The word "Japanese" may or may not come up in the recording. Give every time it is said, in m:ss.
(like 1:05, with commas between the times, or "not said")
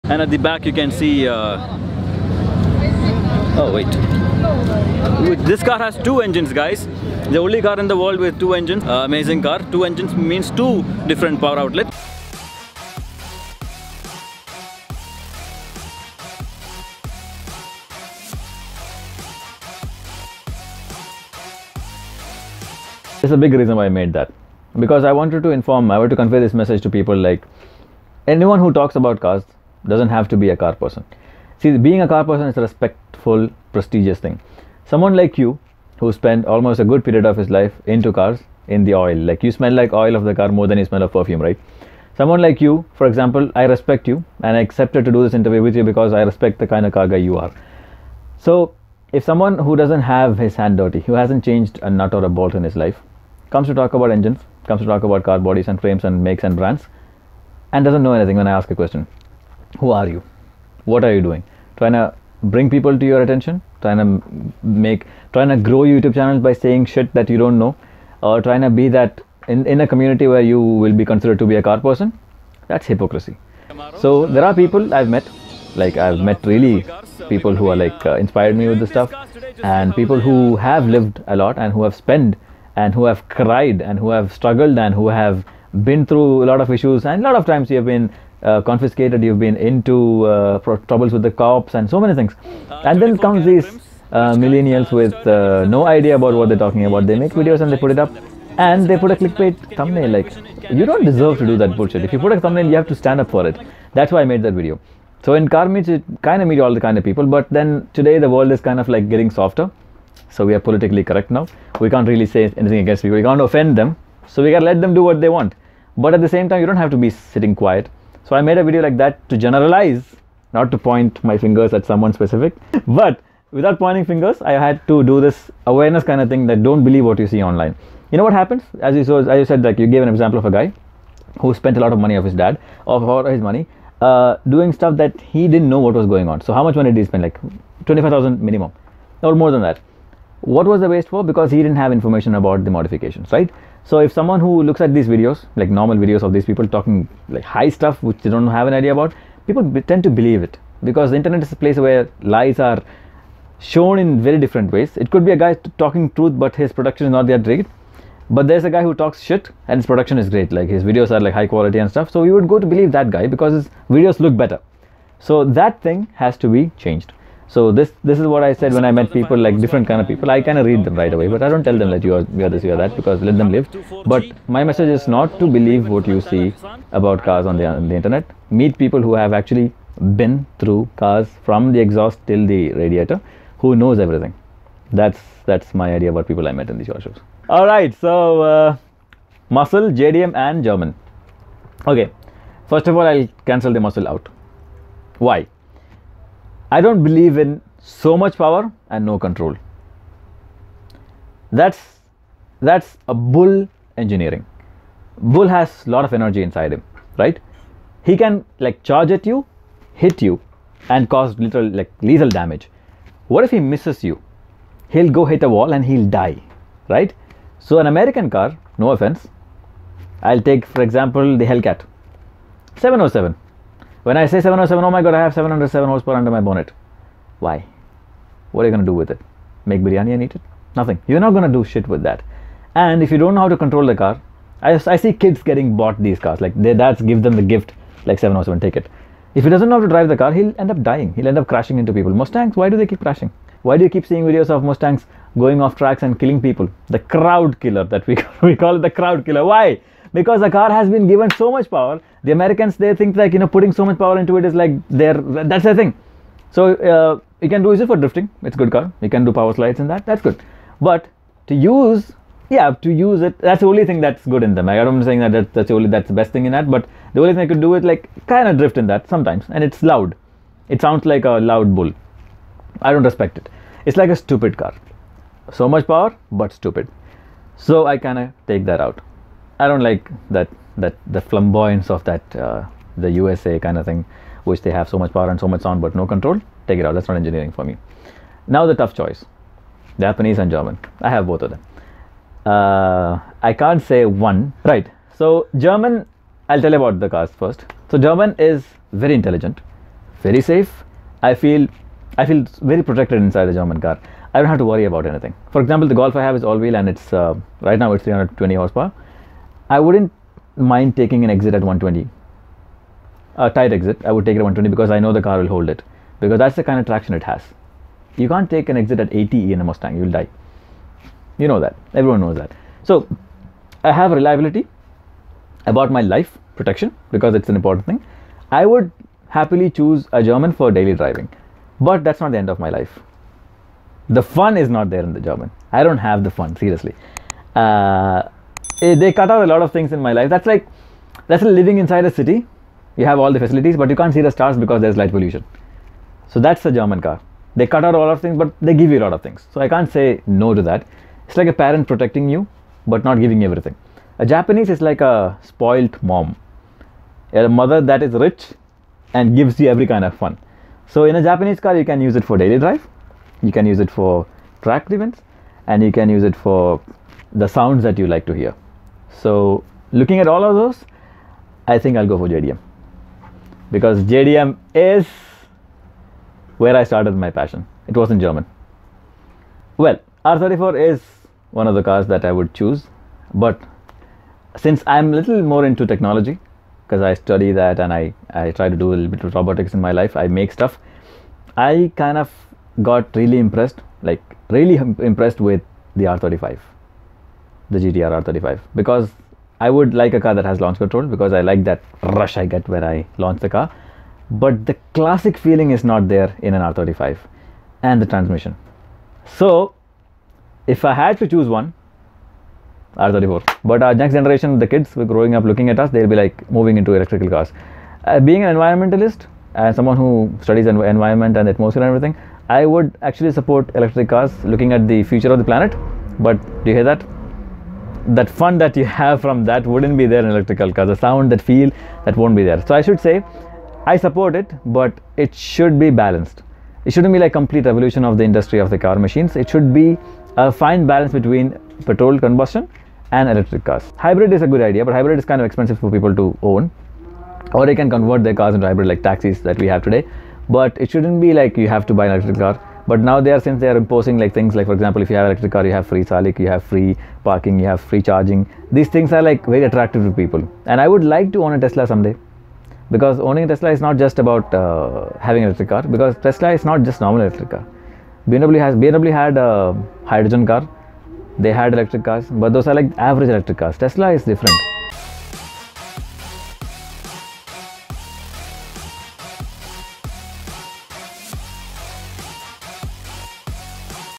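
4:50, 5:54, 6:01.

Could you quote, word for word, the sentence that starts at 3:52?
And if you don't know how to control the car, I, I see kids getting bought these cars.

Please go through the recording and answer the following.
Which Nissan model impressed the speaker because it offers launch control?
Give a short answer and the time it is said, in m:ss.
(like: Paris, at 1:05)
GTR R35, at 6:37.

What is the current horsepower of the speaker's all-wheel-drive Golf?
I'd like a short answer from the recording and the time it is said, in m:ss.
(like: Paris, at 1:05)
320, at 5:08.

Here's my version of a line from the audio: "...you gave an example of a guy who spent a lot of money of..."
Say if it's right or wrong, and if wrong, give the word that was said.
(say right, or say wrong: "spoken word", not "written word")
right.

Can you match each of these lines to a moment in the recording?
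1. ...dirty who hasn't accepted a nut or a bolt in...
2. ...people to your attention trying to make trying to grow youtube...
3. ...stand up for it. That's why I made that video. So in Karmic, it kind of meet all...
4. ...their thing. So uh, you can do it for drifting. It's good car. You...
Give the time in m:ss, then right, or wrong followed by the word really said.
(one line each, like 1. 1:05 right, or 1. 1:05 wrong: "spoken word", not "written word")
1. 0:50 wrong: "changed", not "accepted"
2. 1:02 right
3. 1:42 right
4. 4:15 right.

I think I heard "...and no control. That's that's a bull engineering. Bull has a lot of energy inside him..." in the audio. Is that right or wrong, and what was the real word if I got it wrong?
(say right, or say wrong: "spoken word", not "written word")
right.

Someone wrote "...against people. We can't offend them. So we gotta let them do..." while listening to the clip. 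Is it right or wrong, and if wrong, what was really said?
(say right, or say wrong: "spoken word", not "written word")
right.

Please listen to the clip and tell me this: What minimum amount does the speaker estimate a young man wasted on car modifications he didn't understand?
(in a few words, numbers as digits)
25,000.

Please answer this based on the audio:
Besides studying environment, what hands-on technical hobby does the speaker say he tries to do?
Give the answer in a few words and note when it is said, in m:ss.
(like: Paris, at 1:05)
Robotics, at 6:29.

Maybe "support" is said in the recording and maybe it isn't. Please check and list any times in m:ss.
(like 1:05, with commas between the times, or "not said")
7:03, 7:13.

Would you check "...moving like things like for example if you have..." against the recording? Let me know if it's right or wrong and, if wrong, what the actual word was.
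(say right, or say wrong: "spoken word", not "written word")
wrong: "imposing", not "moving".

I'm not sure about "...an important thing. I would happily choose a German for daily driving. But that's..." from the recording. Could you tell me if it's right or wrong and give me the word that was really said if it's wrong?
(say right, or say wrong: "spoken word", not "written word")
right.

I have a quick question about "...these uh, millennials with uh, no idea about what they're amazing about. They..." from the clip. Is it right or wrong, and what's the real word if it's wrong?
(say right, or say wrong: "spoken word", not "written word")
wrong: "talking", not "amazing".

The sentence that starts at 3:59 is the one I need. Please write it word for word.
If he doesn't know how to drive the car, he'll end up dying.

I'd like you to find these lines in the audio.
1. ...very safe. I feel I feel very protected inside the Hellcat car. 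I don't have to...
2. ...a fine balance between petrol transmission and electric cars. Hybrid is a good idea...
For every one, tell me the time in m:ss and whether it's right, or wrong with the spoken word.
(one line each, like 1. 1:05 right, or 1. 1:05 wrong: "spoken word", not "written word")
1. 5:00 wrong: "German", not "Hellcat"
2. 7:20 wrong: "combustion", not "transmission".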